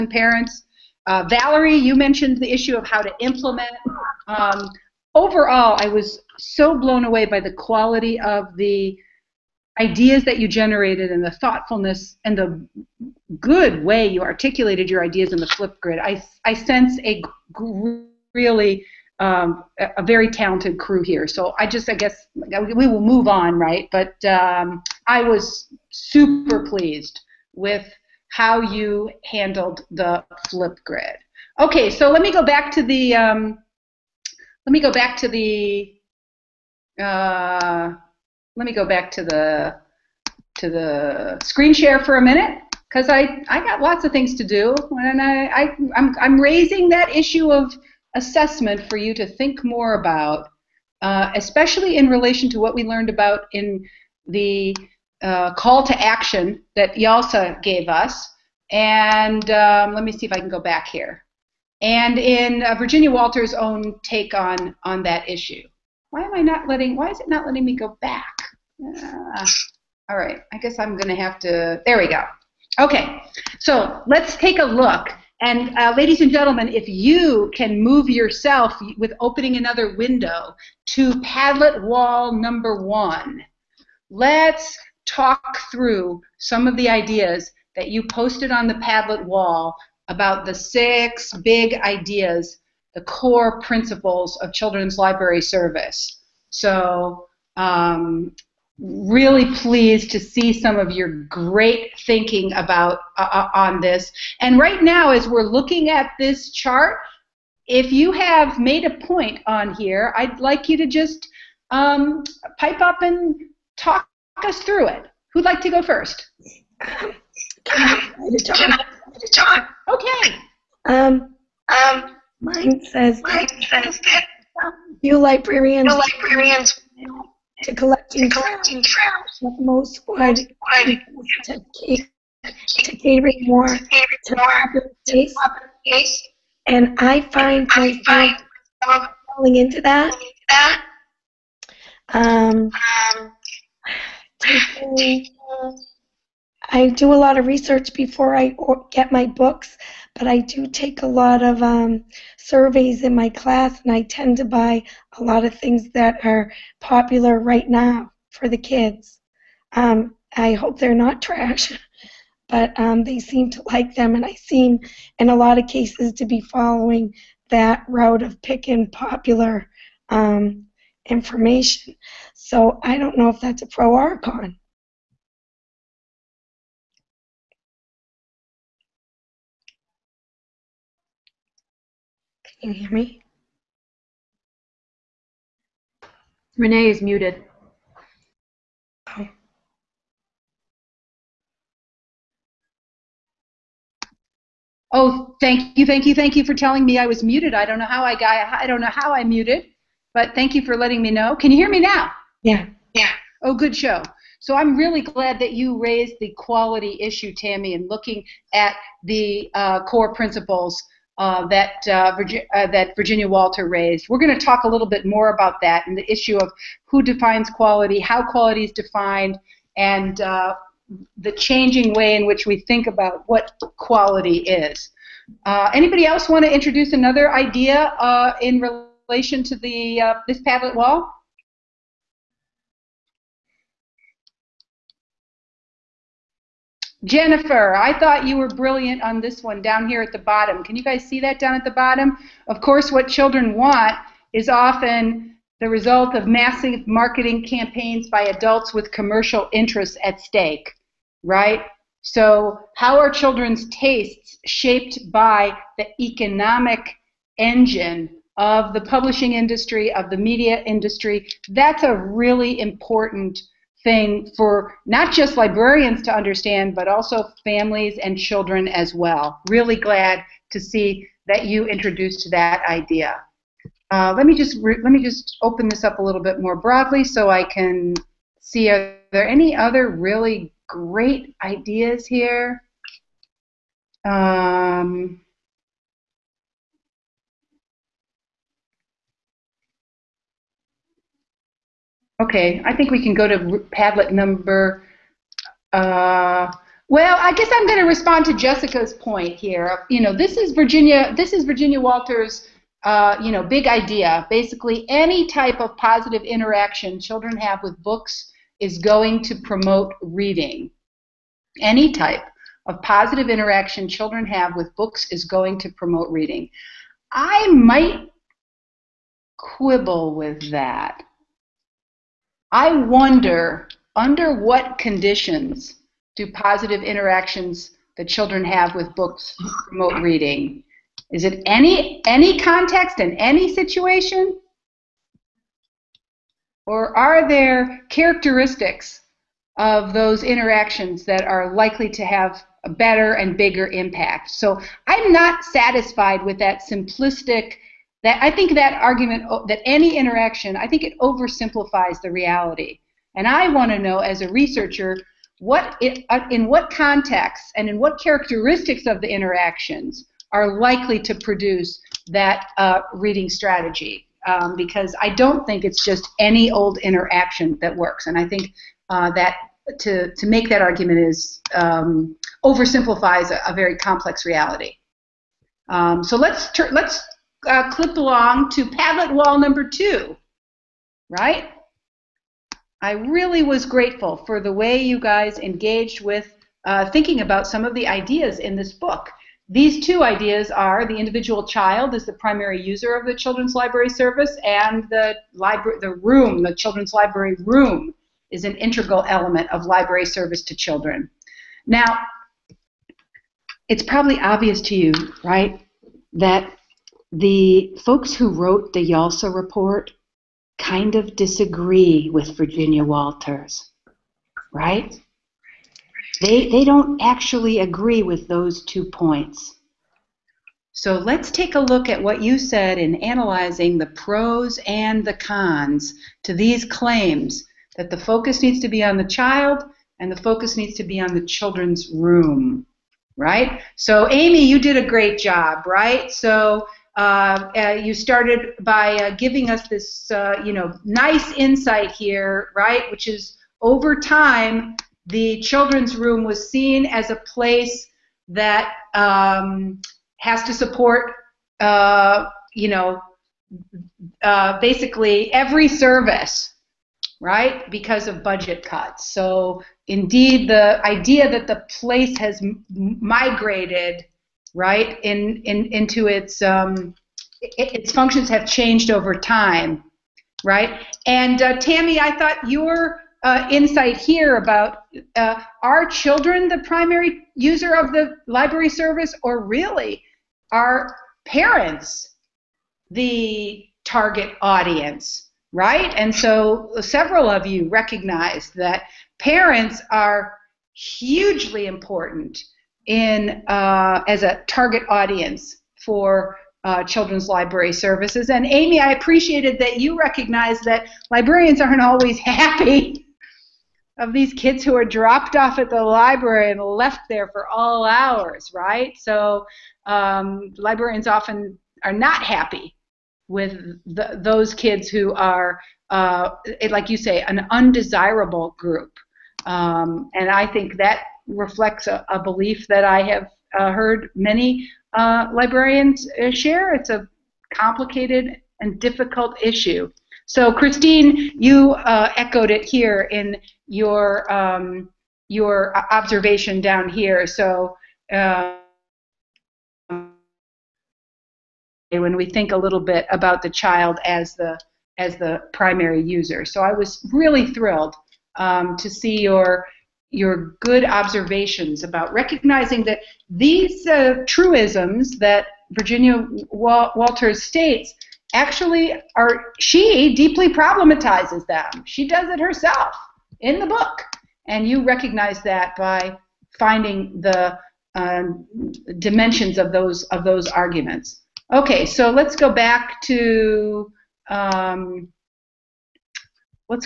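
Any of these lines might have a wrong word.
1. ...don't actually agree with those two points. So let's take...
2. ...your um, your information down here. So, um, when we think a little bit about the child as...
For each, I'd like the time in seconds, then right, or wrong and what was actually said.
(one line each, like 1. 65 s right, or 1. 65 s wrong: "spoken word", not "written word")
1. 416 s right
2. 533 s wrong: "observation", not "information".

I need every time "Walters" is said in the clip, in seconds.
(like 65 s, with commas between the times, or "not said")
63 s, 213 s, 301 s, 412 s, 556 s.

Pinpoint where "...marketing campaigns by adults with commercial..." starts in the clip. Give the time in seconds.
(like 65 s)
246 s.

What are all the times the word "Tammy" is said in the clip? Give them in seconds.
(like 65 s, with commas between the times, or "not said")
207 s, 471 s.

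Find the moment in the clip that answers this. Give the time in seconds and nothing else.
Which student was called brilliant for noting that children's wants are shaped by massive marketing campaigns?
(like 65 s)
237 s.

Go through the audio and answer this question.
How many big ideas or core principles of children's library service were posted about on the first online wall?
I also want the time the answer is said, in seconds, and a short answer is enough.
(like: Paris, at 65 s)
6, at 90 s.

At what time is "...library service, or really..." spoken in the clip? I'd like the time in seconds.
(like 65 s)
478 s.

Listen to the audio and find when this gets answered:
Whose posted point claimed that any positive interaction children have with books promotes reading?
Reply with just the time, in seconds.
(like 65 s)
298 s.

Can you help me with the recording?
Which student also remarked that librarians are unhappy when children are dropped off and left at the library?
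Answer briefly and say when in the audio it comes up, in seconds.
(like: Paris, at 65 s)
Christine, at 530 s.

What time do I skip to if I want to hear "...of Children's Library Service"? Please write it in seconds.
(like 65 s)
94 s.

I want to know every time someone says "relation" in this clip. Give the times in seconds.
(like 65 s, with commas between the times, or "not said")
52 s, 229 s.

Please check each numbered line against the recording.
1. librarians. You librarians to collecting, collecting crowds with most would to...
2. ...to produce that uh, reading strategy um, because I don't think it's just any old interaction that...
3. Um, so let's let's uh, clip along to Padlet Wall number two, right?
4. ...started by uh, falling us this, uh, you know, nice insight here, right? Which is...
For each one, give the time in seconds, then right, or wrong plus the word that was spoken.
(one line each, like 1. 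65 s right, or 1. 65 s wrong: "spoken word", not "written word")
1. 125 s right
2. 360 s right
3. 375 s right
4. 437 s wrong: "giving", not "falling".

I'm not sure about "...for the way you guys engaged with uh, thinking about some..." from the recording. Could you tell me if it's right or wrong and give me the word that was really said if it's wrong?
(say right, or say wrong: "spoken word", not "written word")
right.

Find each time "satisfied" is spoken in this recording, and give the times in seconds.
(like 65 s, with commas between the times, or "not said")
345 s.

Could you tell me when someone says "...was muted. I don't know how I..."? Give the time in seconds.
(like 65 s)
197 s.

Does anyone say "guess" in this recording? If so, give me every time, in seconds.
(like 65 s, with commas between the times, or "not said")
21 s, 70 s, 297 s.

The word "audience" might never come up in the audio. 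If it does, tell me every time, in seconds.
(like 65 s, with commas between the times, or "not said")
484 s, 494 s.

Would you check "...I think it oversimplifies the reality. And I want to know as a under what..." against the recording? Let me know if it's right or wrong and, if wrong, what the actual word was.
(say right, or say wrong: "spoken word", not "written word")
wrong: "researcher", not "under".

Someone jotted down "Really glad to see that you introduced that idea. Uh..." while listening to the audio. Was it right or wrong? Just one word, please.
right.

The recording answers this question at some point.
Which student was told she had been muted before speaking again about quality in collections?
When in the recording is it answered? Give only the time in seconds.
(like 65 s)
186 s.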